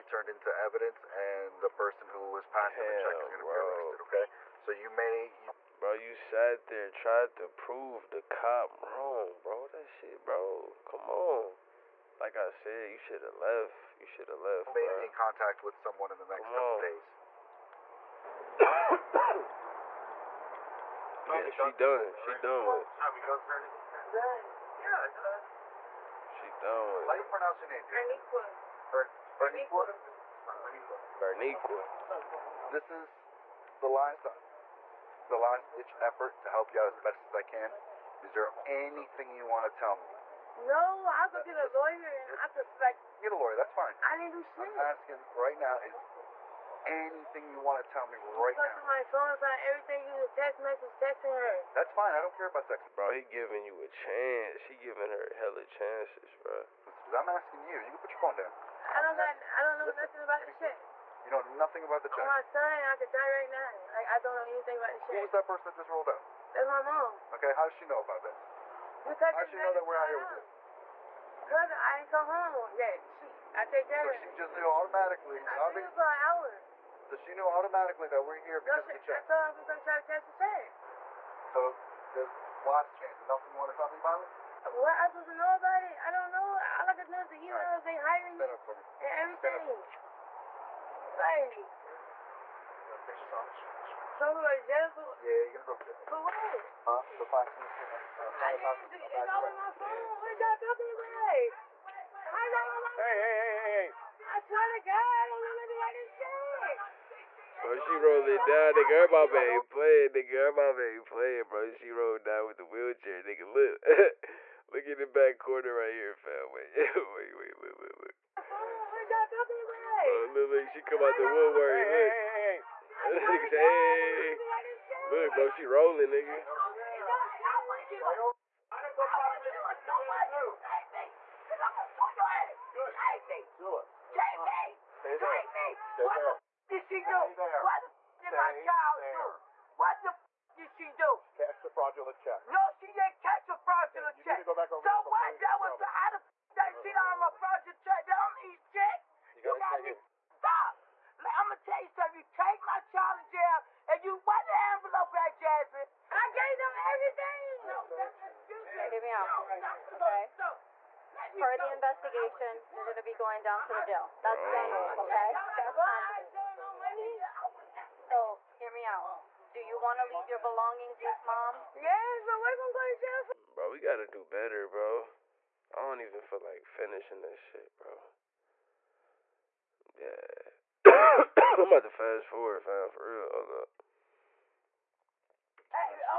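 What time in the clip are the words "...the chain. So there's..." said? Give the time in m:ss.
1:20.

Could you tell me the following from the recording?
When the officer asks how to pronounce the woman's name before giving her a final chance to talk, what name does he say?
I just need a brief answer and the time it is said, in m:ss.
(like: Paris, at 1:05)
Berniqua, at 0:31.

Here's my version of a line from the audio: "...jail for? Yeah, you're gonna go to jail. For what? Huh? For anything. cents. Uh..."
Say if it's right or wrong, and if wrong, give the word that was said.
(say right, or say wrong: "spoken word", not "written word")
wrong: "passing", not "anything".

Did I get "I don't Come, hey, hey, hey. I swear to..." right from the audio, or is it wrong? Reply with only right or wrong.
wrong.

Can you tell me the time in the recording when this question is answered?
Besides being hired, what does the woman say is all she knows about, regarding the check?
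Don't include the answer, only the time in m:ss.
1:27.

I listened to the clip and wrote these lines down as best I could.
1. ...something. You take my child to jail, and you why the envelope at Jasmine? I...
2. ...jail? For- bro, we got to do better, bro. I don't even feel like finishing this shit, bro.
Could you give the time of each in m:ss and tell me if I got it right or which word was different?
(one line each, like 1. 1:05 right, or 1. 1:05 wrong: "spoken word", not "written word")
1. 2:31 right
2. 2:53 right.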